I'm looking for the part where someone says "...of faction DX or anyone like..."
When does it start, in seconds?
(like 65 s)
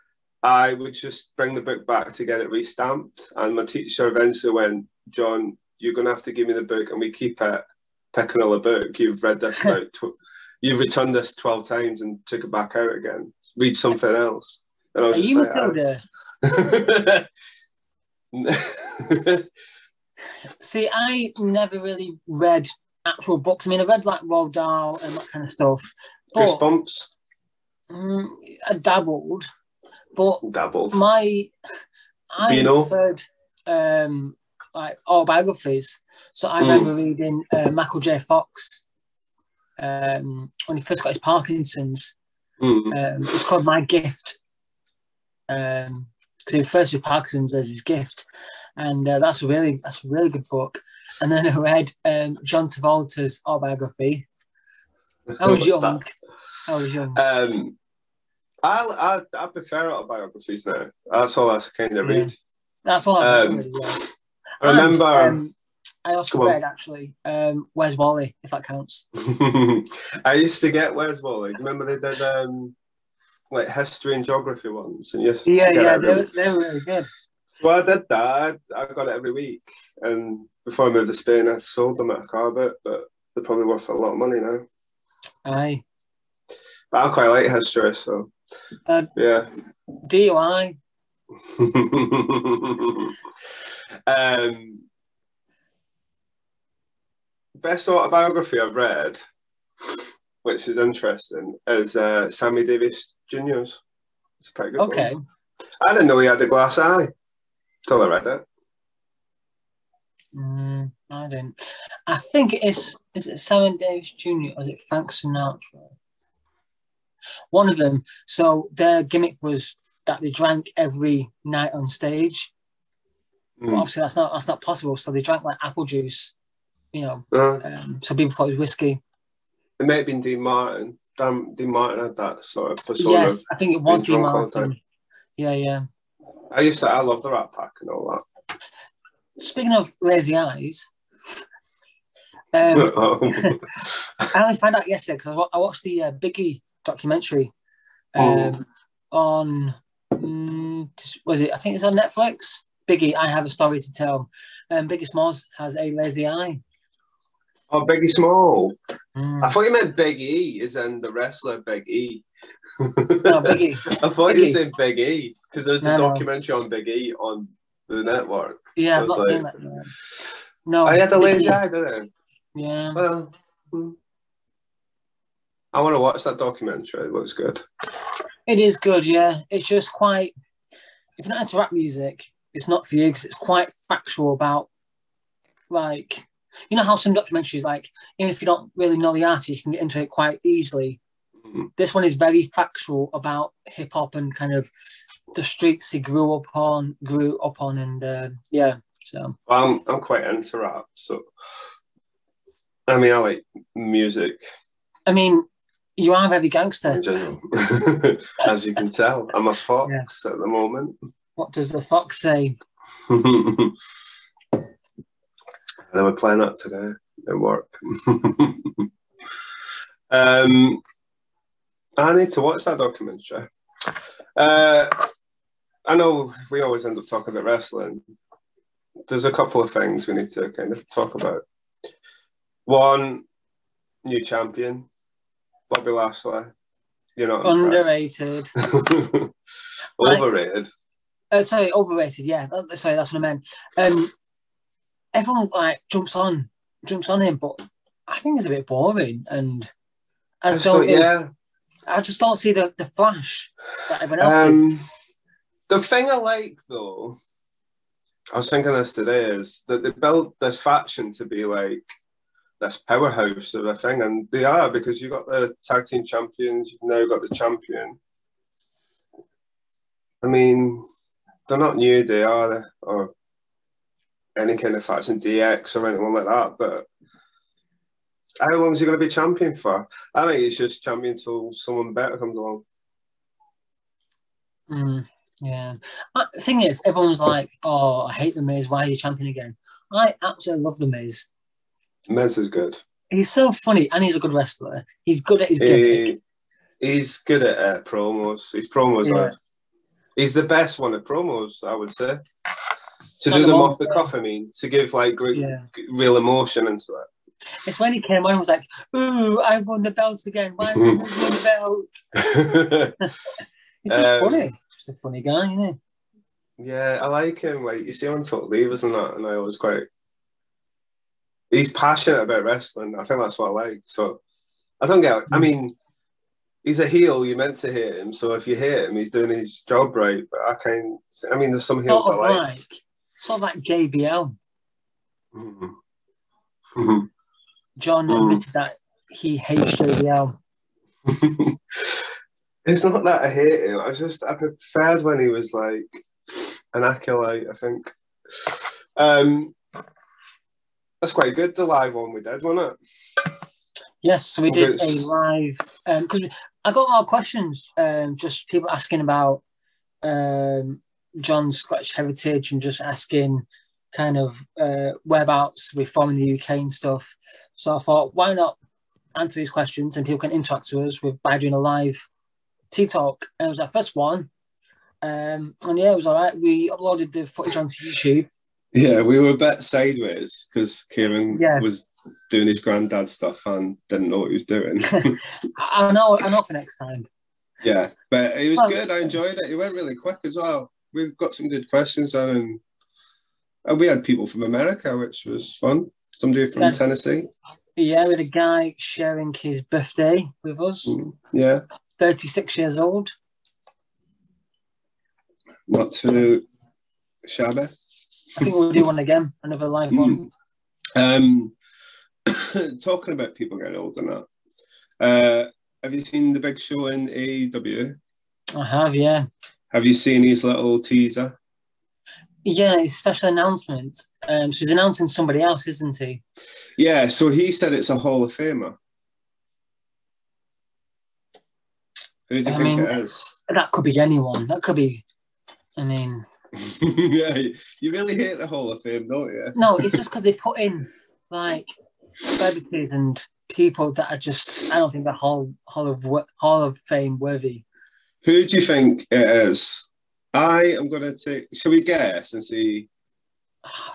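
274 s.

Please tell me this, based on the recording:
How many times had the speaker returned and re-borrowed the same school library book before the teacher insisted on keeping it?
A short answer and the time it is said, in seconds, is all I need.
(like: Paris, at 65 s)
12, at 11 s.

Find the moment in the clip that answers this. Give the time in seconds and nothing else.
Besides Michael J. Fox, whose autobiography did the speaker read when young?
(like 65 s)
52 s.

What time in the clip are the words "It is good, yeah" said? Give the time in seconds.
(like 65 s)
178 s.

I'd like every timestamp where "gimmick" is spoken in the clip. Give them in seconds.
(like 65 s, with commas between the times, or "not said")
119 s, 295 s.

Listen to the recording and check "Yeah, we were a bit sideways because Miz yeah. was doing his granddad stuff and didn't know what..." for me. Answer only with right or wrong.
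wrong.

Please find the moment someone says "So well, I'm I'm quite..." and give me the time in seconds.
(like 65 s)
199 s.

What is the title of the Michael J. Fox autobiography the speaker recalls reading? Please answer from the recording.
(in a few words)
My Gift.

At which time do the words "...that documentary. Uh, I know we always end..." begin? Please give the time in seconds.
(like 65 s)
222 s.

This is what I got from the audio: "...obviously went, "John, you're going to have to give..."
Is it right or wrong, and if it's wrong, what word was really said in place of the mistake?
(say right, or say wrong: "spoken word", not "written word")
wrong: "eventually", not "obviously".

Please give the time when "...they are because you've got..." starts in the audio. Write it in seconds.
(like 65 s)
264 s.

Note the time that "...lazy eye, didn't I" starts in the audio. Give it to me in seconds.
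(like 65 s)
171 s.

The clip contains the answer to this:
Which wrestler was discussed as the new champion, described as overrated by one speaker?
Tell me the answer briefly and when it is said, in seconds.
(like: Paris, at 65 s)
Bobby Lashley, at 235 s.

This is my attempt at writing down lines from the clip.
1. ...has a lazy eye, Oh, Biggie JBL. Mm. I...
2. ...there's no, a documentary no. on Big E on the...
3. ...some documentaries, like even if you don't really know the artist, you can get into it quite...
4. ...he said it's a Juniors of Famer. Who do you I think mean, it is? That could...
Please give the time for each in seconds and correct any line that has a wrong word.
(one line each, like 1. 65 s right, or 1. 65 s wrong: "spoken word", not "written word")
1. 155 s wrong: "Small", not "JBL"
2. 165 s right
3. 186 s right
4. 427 s wrong: "Hall", not "Juniors".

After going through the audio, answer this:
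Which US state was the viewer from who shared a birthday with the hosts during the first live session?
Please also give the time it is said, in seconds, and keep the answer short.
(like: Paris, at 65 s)
Tennessee, at 396 s.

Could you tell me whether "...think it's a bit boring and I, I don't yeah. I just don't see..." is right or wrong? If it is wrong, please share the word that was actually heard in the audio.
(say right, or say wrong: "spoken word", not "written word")
right.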